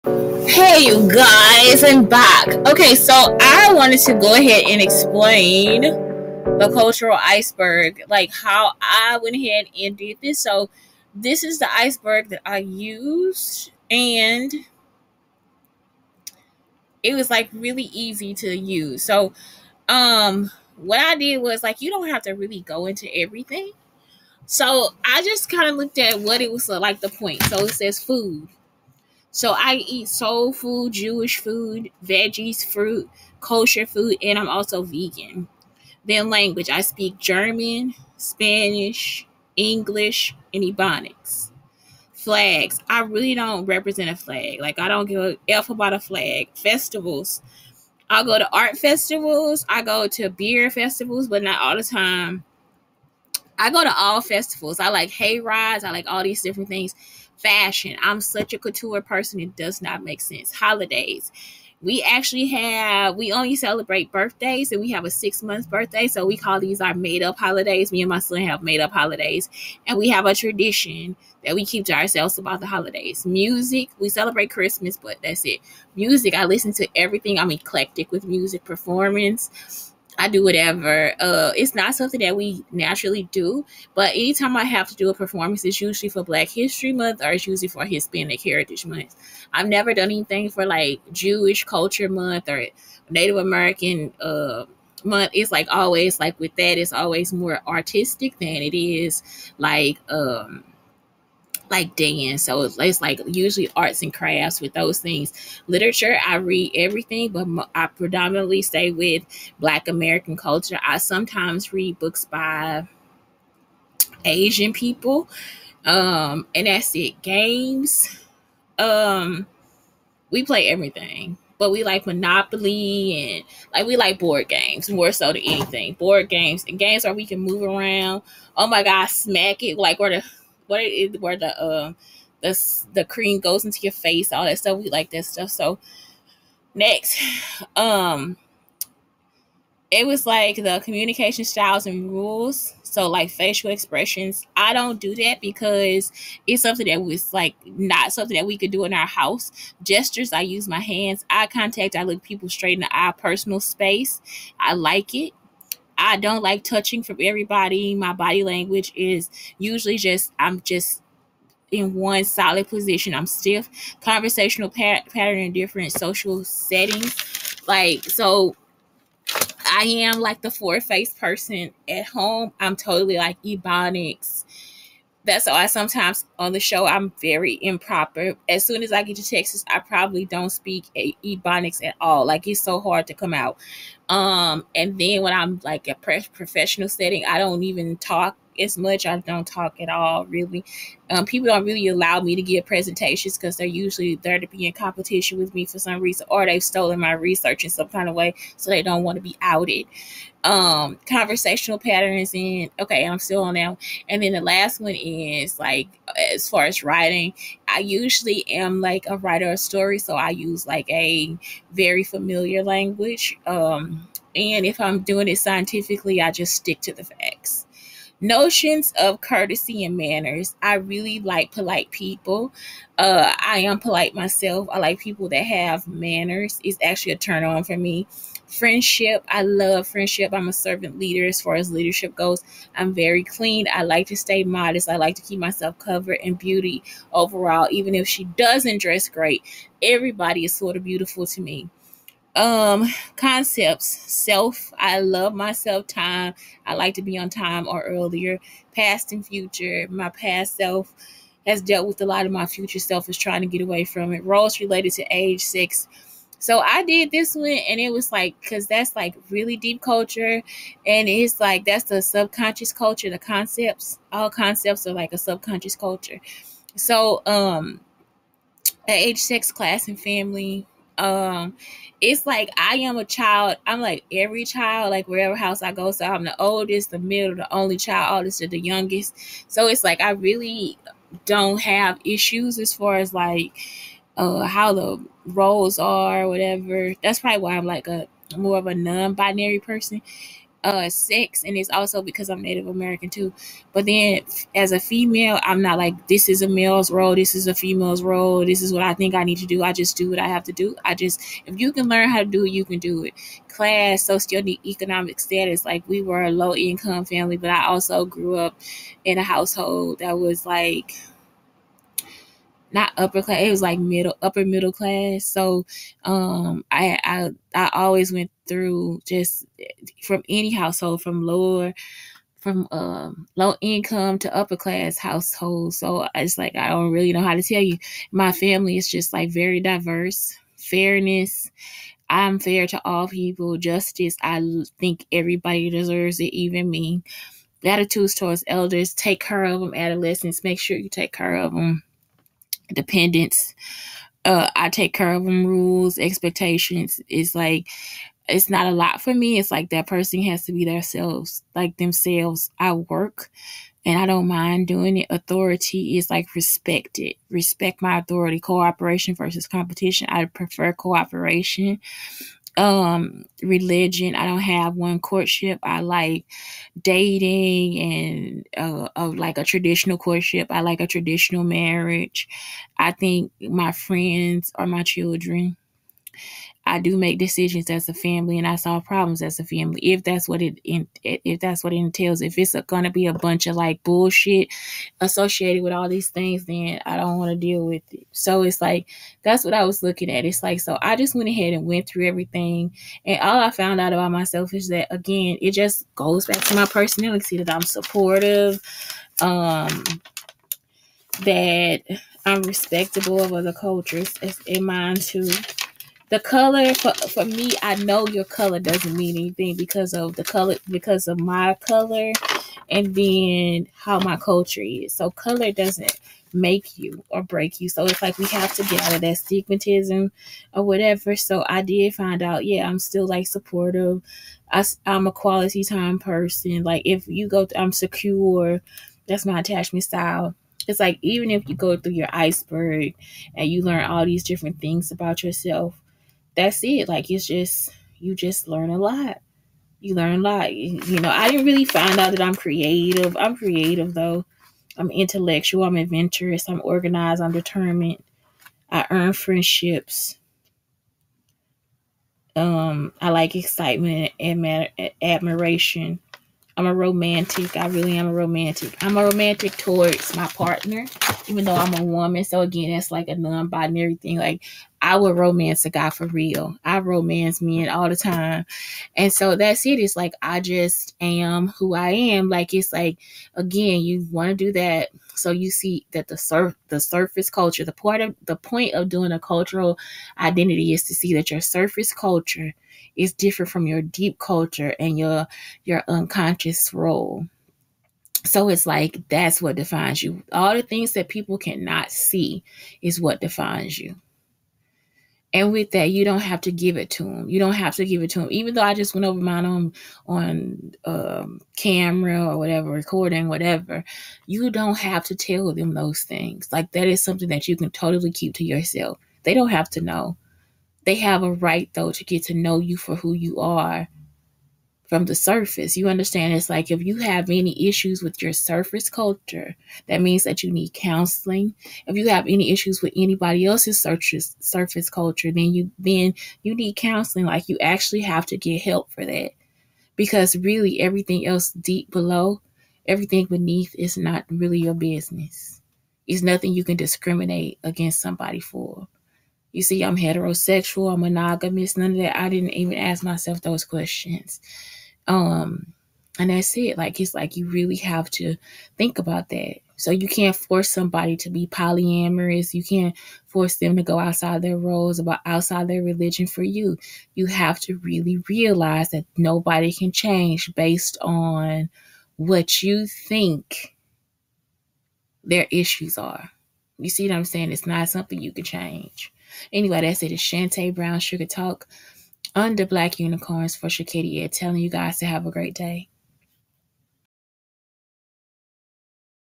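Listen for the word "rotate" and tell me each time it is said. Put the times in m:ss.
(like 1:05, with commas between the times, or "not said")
not said.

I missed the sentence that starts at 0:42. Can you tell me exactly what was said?
Flags, I really don't represent a flag.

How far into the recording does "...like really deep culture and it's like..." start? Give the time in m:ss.
4:18.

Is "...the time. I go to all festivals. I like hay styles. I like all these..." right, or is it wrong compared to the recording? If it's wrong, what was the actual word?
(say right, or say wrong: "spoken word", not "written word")
wrong: "rides", not "styles".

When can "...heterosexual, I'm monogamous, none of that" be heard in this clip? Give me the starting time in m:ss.
8:59.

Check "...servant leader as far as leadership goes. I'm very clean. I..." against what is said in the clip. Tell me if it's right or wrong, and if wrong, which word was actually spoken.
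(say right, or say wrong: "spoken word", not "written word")
right.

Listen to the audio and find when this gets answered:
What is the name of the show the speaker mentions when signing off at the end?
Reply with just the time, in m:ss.
9:30.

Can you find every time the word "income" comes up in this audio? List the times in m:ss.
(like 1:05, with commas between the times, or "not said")
5:06, 5:23.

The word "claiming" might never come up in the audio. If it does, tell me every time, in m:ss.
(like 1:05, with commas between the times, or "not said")
not said.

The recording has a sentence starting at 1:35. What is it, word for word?
It's like always like with that, it's always more artistic than it is like um like dance.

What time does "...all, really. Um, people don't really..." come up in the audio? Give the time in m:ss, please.
3:09.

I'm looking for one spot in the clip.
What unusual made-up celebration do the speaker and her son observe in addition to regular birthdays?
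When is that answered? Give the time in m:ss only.
1:05.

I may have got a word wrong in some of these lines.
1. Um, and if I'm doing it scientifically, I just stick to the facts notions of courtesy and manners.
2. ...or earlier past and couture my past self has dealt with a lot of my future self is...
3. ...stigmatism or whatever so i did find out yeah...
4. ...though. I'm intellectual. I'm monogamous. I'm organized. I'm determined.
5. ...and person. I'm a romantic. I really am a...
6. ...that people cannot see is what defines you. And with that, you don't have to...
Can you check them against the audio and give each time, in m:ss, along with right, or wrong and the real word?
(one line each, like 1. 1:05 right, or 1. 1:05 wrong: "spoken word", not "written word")
1. 3:33 right
2. 4:07 wrong: "future", not "couture"
3. 6:59 right
4. 7:23 wrong: "adventurous", not "monogamous"
5. 7:34 wrong: "admiration", not "person"
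6. 8:10 right.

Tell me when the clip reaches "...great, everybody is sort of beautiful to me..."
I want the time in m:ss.
3:59.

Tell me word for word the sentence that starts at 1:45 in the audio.
Literature, I read everything, but I predominantly stay with Black American culture.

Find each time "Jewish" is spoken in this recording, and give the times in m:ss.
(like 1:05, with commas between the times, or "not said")
0:30, 1:31.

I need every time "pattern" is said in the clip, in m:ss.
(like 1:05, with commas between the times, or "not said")
2:45, 3:21.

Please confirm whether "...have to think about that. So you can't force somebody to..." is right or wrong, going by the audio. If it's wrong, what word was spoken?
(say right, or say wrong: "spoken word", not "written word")
right.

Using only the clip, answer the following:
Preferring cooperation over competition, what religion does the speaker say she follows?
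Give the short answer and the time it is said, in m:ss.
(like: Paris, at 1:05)
none, at 6:04.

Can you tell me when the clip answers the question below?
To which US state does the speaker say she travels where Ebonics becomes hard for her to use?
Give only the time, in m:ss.
2:59.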